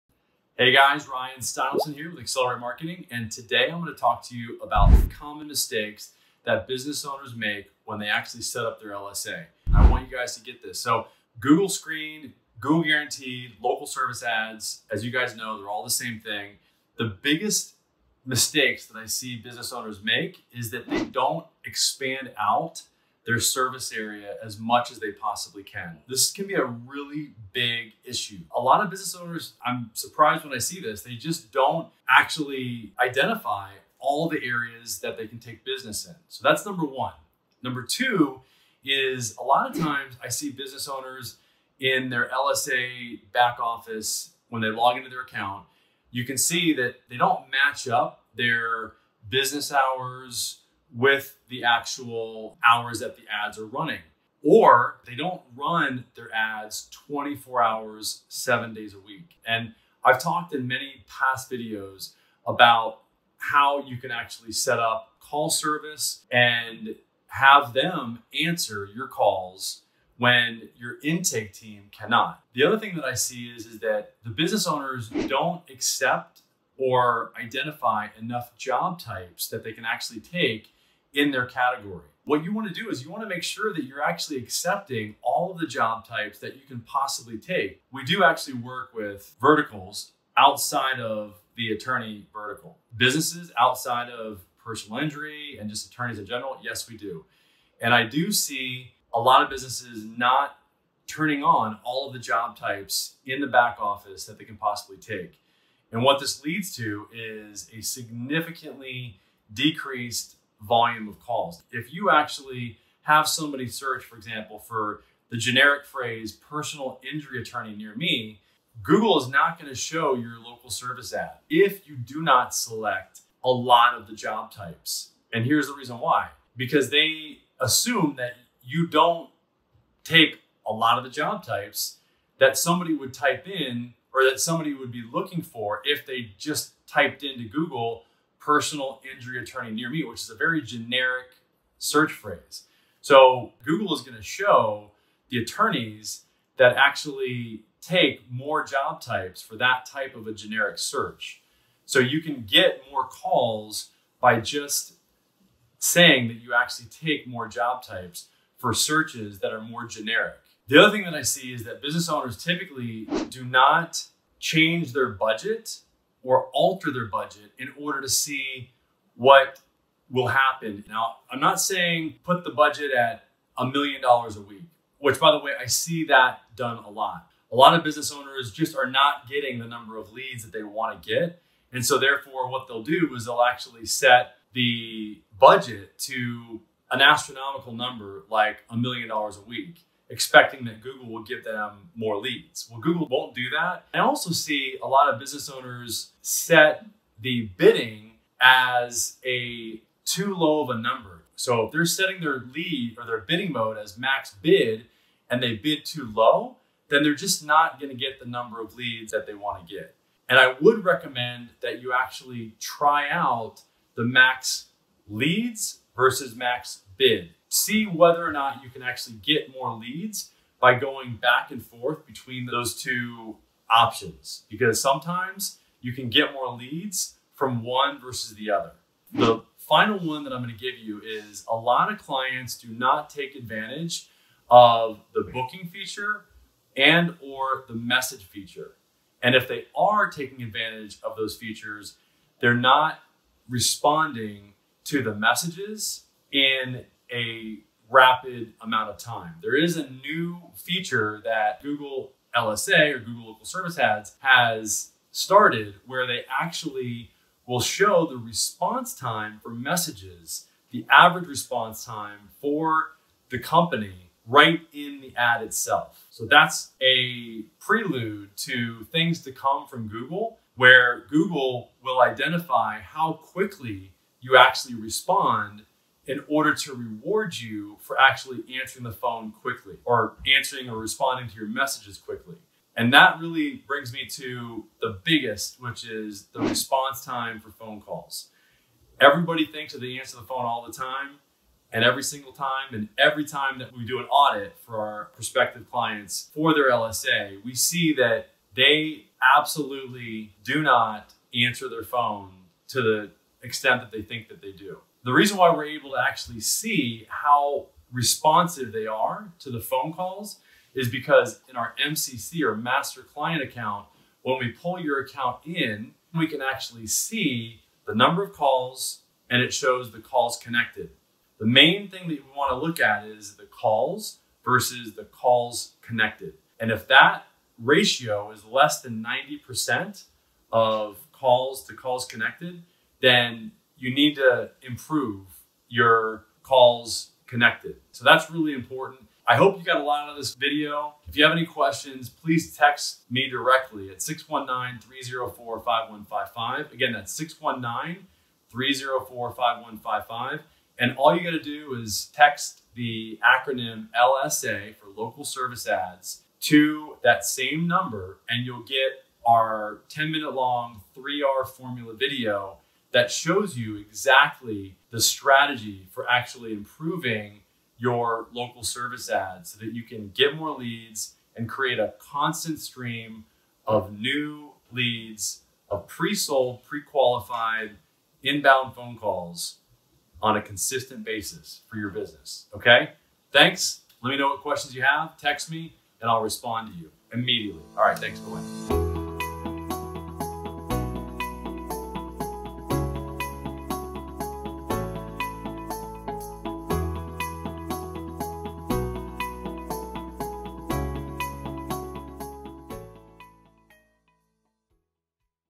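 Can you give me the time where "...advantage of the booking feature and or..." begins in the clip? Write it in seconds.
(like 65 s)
233 s.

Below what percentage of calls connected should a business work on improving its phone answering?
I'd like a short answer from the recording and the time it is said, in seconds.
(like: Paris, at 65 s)
90%, at 329 s.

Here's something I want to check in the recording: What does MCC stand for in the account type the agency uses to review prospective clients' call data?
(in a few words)
master client account.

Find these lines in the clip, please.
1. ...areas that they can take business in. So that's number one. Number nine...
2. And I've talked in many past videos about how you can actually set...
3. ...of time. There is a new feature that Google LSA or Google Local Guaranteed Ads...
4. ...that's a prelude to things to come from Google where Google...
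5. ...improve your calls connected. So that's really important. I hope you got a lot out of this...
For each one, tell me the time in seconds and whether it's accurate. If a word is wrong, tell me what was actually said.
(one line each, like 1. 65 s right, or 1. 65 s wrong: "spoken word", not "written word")
1. 34 s wrong: "two", not "nine"
2. 59 s right
3. 248 s wrong: "Service", not "Guaranteed"
4. 266 s right
5. 334 s right.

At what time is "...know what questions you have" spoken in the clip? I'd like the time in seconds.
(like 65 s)
384 s.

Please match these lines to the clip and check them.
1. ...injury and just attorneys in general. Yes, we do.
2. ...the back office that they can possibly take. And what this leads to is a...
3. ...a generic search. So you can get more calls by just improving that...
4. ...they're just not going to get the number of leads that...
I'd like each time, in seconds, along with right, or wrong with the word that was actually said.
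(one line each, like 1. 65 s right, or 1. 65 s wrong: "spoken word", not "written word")
1. 94 s right
2. 103 s right
3. 150 s wrong: "saying", not "improving"
4. 207 s right.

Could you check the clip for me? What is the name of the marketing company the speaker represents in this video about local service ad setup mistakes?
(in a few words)
Accelerate Marketing.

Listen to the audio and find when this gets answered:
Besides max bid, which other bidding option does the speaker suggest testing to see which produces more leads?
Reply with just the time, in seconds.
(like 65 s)
214 s.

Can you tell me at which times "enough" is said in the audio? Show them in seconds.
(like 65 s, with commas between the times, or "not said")
78 s.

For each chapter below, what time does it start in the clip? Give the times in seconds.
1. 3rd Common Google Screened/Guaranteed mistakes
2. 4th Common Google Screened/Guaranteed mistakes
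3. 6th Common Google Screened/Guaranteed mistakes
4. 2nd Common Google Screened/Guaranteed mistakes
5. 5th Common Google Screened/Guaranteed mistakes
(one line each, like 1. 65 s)
1. 70 s
2. 159 s
3. 282 s
4. 37 s
5. 229 s.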